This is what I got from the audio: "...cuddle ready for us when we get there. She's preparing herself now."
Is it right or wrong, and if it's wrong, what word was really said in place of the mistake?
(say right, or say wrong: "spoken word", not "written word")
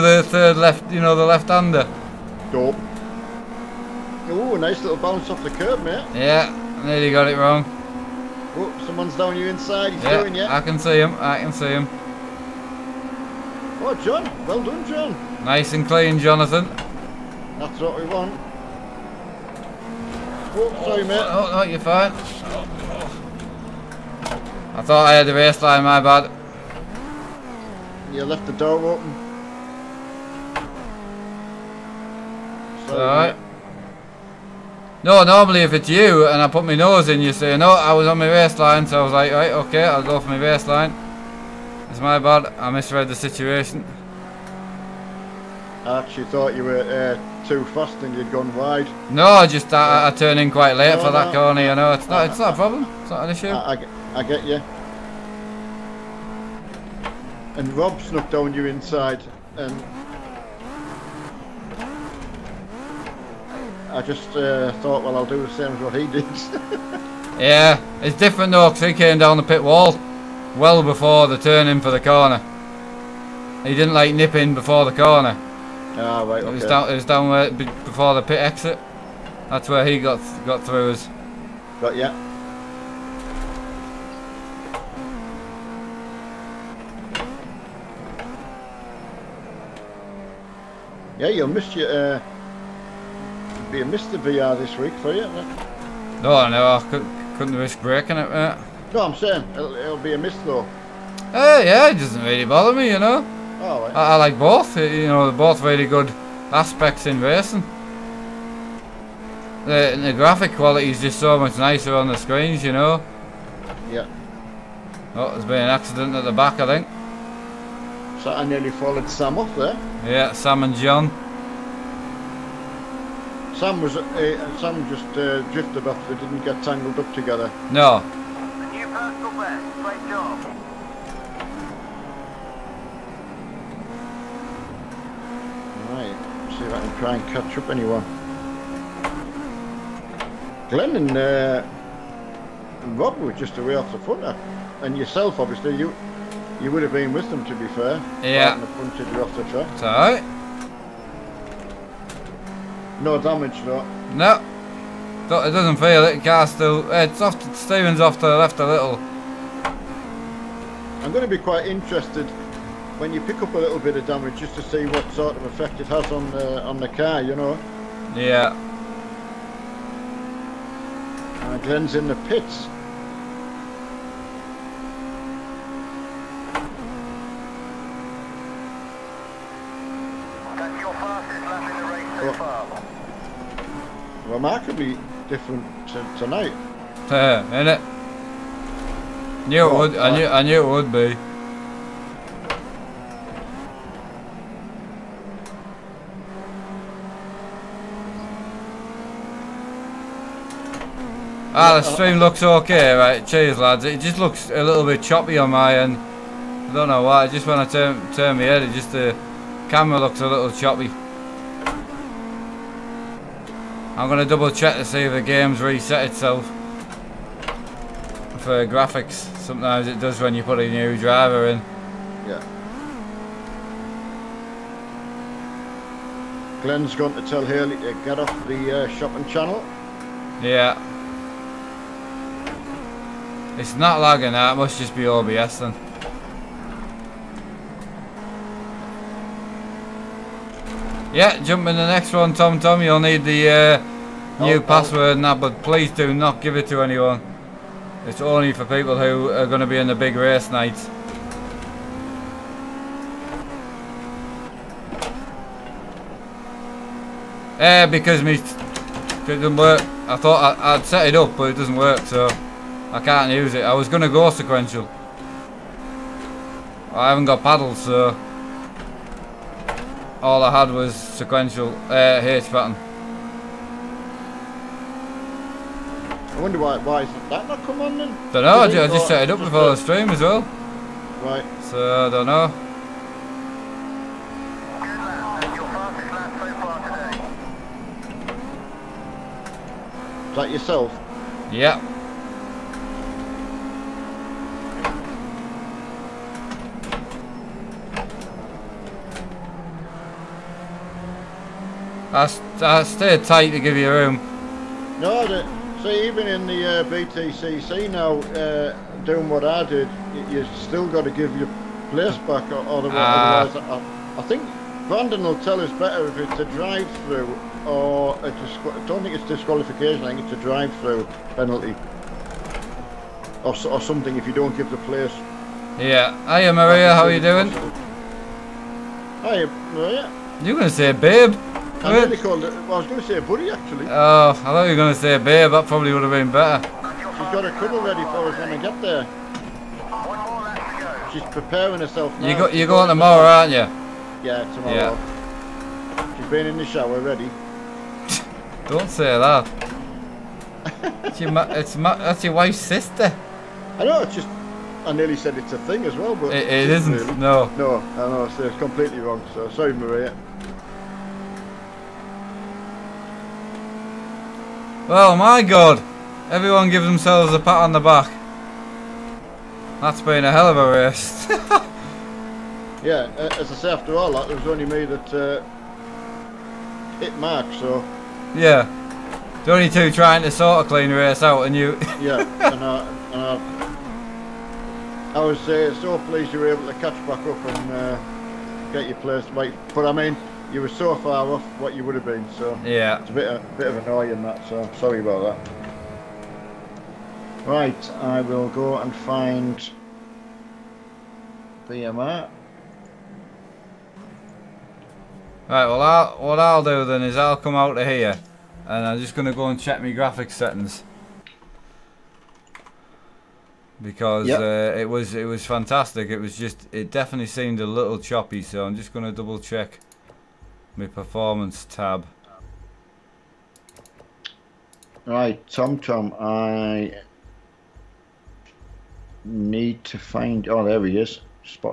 right.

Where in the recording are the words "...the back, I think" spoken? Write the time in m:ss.
1:56.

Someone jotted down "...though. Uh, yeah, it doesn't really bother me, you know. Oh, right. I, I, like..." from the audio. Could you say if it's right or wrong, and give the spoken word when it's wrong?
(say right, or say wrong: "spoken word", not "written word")
right.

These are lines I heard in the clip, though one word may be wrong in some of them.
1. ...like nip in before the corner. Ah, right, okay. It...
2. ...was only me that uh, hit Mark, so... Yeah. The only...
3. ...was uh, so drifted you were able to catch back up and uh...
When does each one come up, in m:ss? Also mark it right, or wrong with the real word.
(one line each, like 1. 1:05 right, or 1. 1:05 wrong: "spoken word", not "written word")
1. 1:13 right
2. 6:14 right
3. 6:25 wrong: "pleased", not "drifted".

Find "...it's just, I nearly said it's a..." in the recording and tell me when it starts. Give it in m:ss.
5:54.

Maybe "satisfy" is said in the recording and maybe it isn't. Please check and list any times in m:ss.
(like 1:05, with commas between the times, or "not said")
not said.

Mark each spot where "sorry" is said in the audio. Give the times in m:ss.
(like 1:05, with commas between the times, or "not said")
0:20, 5:59, 6:34.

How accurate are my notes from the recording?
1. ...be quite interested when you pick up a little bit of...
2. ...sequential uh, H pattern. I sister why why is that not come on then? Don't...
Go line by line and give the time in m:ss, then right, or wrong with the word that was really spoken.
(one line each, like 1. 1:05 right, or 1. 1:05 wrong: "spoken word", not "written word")
1. 2:41 right
2. 4:30 wrong: "wonder", not "sister".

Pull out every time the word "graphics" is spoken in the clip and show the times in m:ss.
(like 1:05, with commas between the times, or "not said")
1:50, 3:38, 6:49.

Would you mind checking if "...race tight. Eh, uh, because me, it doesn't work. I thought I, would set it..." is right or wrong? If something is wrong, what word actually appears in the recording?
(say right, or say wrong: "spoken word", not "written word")
wrong: "night", not "tight".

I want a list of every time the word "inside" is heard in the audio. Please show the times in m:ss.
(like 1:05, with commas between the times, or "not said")
0:09, 0:58.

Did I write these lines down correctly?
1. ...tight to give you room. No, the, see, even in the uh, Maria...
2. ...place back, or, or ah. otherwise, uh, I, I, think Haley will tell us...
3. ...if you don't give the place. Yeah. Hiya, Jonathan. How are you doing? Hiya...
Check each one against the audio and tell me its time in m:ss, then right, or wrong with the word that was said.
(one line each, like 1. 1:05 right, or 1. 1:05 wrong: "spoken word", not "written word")
1. 5:03 wrong: "BTCC", not "Maria"
2. 5:11 wrong: "Brandon", not "Haley"
3. 5:24 wrong: "Maria", not "Jonathan".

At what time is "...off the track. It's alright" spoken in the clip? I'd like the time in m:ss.
2:29.